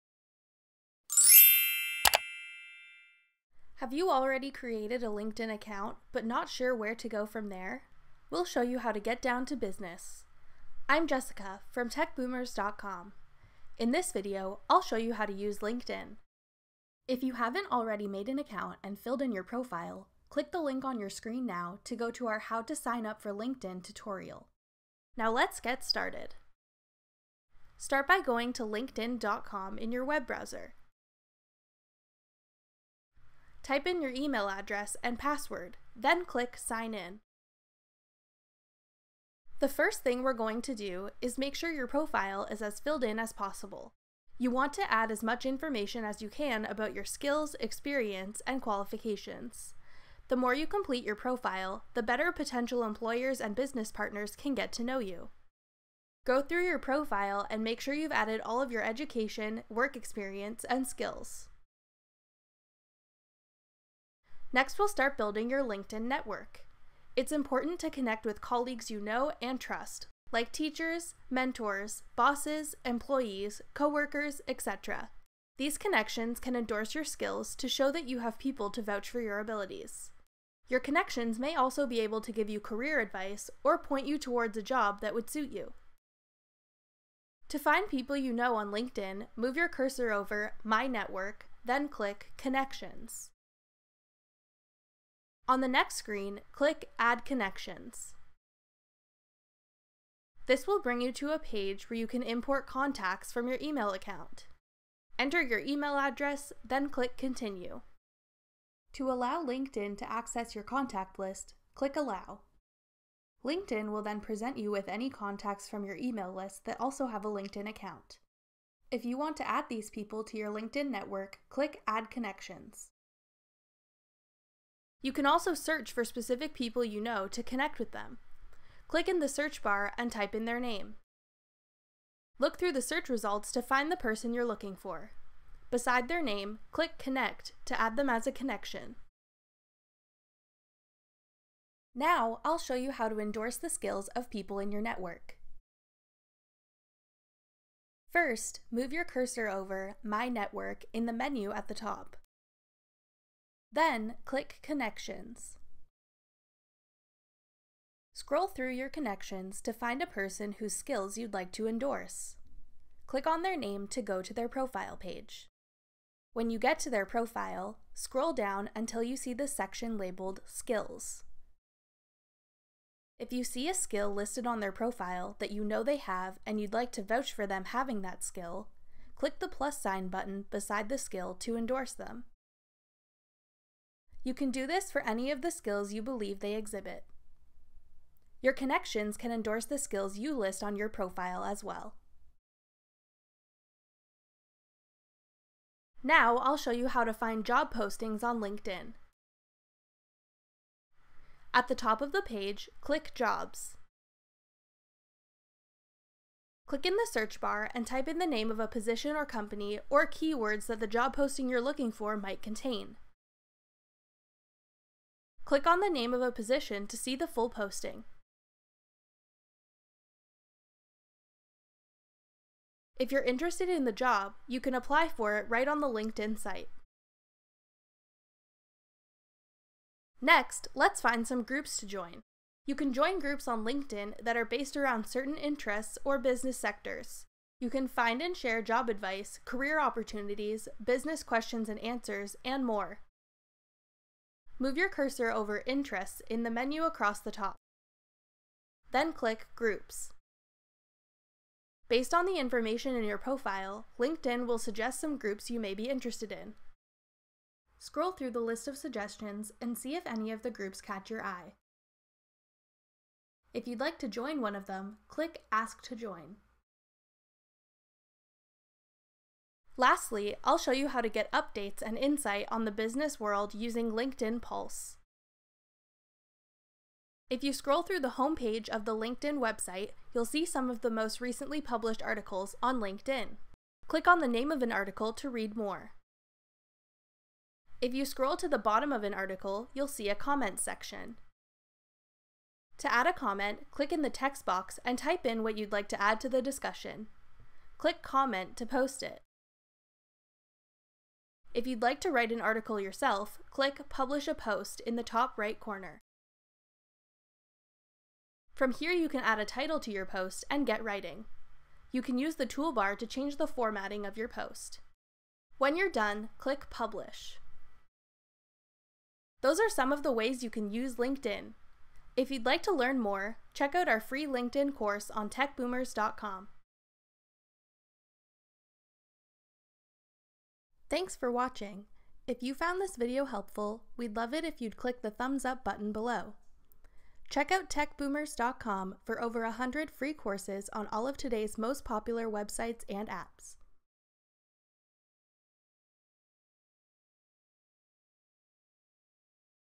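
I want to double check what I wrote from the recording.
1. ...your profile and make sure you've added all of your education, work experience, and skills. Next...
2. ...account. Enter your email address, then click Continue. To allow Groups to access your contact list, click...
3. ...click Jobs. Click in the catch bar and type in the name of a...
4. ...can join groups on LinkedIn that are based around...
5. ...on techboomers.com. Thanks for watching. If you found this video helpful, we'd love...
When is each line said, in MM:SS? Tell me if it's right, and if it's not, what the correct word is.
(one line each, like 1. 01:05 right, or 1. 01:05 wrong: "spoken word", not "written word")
1. 00:56 right
2. 01:43 wrong: "LinkedIn", not "Groups"
3. 03:22 wrong: "search", not "catch"
4. 03:52 right
5. 05:25 right.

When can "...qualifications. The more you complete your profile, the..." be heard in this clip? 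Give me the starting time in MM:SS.
00:48.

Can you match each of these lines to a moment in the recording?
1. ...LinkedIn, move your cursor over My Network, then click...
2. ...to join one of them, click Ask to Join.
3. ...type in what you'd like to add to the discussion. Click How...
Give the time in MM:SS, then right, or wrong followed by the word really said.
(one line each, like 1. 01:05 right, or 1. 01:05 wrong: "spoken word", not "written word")
1. 01:28 right
2. 04:23 right
3. 04:54 wrong: "Comment", not "How".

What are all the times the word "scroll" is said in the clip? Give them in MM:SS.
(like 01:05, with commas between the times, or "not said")
02:38, 02:47, 04:17, 04:37, 04:48.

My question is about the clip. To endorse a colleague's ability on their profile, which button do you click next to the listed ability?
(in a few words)
plus sign.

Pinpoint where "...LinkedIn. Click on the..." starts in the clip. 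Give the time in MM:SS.
04:42.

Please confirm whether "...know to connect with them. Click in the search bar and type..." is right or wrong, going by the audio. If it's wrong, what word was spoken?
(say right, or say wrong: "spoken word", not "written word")
right.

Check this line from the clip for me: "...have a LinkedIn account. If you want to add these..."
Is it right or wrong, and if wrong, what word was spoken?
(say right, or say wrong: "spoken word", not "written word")
right.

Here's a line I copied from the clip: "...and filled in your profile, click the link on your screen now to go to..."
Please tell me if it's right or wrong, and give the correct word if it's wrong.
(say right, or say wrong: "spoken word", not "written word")
right.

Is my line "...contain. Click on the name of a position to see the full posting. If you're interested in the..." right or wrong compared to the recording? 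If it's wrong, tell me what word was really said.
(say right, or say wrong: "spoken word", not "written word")
right.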